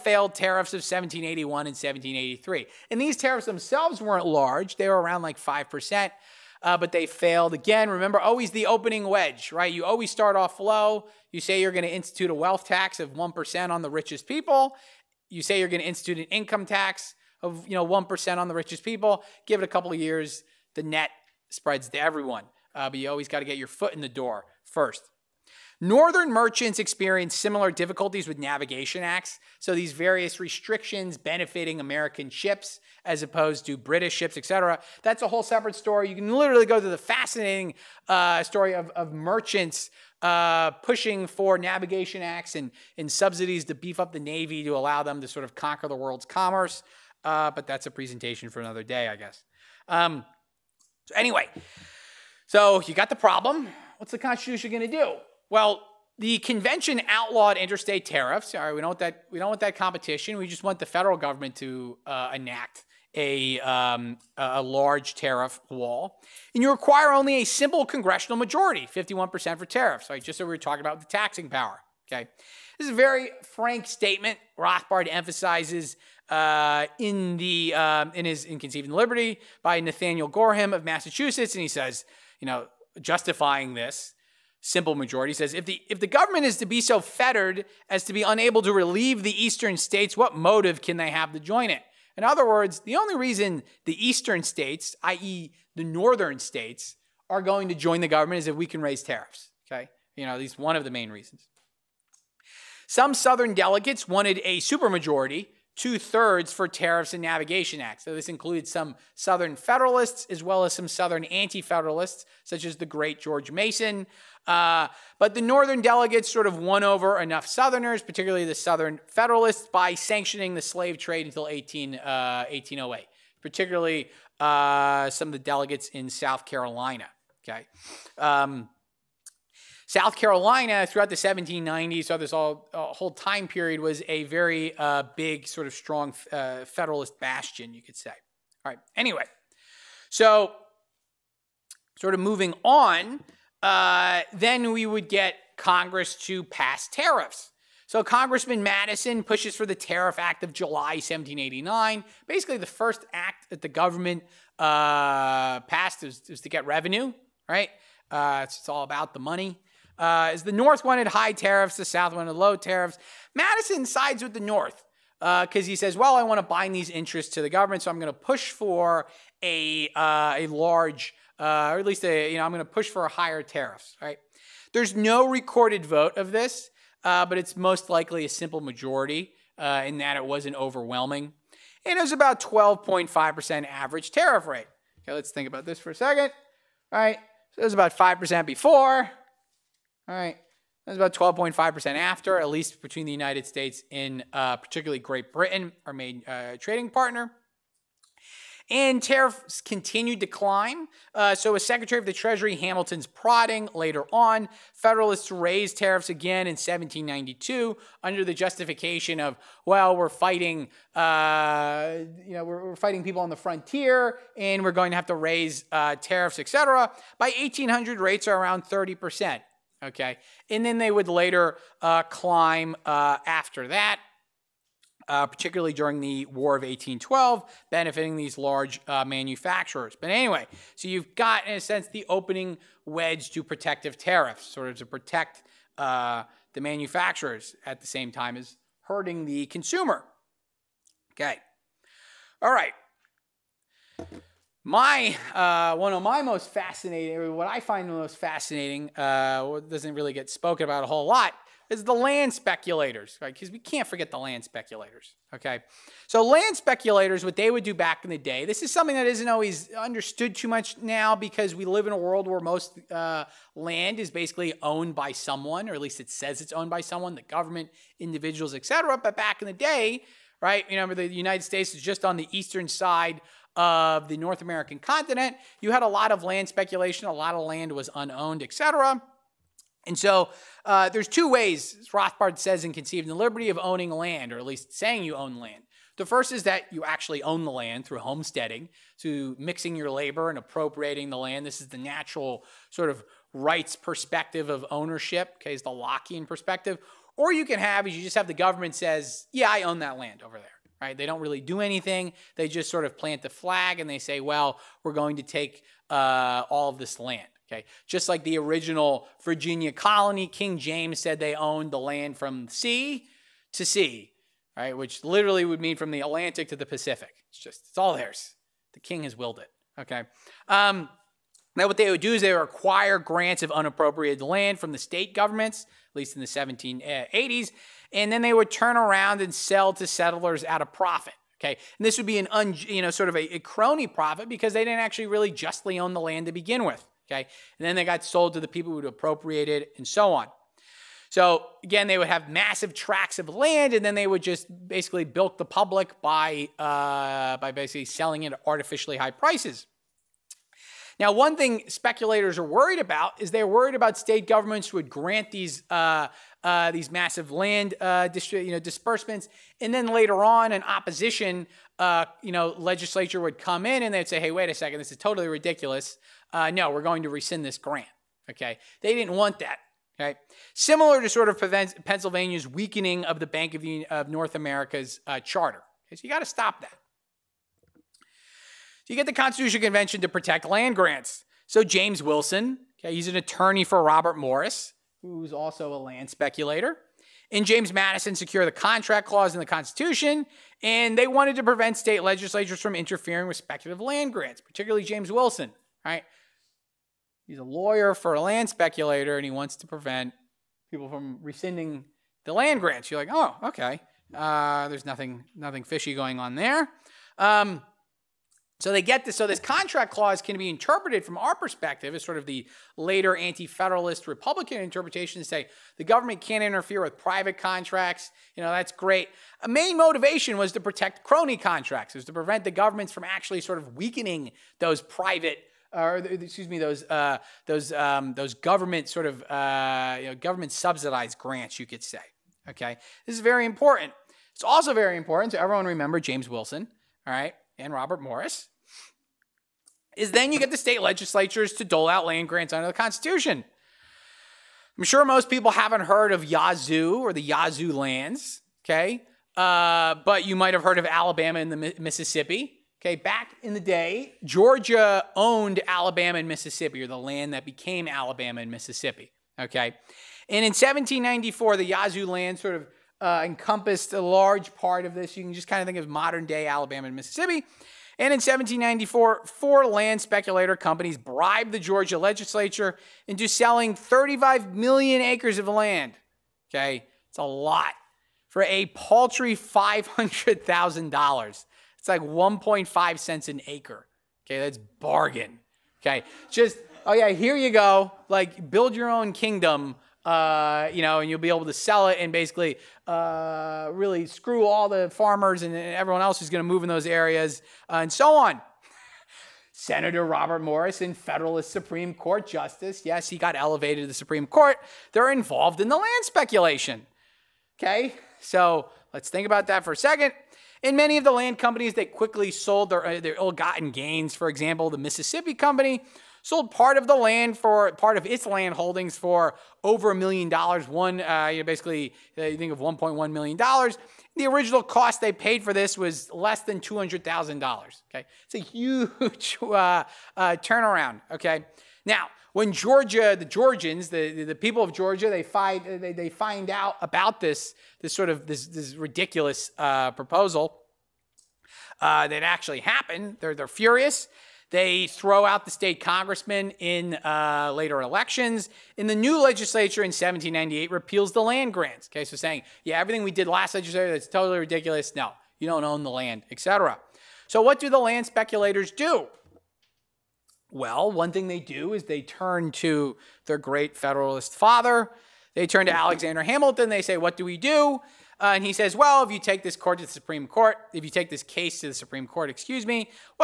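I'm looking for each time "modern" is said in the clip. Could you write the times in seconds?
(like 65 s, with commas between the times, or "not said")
465 s.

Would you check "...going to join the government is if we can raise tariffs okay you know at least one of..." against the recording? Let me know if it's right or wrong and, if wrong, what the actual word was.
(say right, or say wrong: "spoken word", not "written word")
right.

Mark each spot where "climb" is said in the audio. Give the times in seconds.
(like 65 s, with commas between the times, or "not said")
200 s, 222 s.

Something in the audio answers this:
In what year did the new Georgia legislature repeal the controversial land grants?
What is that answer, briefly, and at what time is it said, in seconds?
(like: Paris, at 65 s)
1798, at 549 s.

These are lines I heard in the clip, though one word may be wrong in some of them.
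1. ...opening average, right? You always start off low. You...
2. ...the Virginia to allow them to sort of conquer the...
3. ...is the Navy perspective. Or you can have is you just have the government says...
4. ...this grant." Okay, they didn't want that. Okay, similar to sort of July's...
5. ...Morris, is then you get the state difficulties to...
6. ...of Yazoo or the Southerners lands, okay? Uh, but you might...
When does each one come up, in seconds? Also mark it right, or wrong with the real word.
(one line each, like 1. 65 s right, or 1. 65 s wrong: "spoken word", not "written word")
1. 8 s wrong: "wedge", not "average"
2. 44 s wrong: "Navy", not "Virginia"
3. 295 s wrong: "Lockean", not "Navy"
4. 367 s wrong: "Pennsylvania", not "July"
5. 438 s wrong: "legislatures", not "difficulties"
6. 446 s wrong: "Yazoo", not "Southerners".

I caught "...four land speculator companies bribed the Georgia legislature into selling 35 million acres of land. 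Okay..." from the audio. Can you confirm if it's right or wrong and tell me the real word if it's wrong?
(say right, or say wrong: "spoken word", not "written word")
right.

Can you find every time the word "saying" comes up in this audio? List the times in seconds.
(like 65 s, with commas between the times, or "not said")
284 s, 552 s.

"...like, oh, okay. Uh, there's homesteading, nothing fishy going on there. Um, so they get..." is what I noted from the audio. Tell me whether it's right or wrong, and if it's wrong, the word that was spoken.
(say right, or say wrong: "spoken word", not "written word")
wrong: "nothing", not "homesteading".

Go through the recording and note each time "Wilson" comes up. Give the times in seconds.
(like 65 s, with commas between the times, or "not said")
382 s, 395 s, 436 s.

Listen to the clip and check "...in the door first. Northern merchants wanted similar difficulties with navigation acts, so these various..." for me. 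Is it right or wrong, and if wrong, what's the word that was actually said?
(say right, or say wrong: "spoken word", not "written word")
wrong: "experienced", not "wanted".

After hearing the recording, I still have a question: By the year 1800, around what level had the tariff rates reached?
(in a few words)
30%.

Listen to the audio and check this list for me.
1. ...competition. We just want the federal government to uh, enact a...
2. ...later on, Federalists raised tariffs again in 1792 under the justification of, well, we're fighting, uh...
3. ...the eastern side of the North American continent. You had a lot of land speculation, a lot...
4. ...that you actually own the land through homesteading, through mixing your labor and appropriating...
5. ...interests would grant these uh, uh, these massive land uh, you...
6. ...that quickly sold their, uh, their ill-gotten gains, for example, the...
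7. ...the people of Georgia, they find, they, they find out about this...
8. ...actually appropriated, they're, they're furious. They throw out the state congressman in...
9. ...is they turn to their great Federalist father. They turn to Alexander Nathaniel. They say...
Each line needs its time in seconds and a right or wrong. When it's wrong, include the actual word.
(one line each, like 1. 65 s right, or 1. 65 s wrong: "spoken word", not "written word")
1. 59 s right
2. 203 s right
3. 272 s right
4. 286 s right
5. 354 s wrong: "governments", not "interests"
6. 511 s right
7. 534 s right
8. 542 s wrong: "happened", not "appropriated"
9. 561 s wrong: "Hamilton", not "Nathaniel".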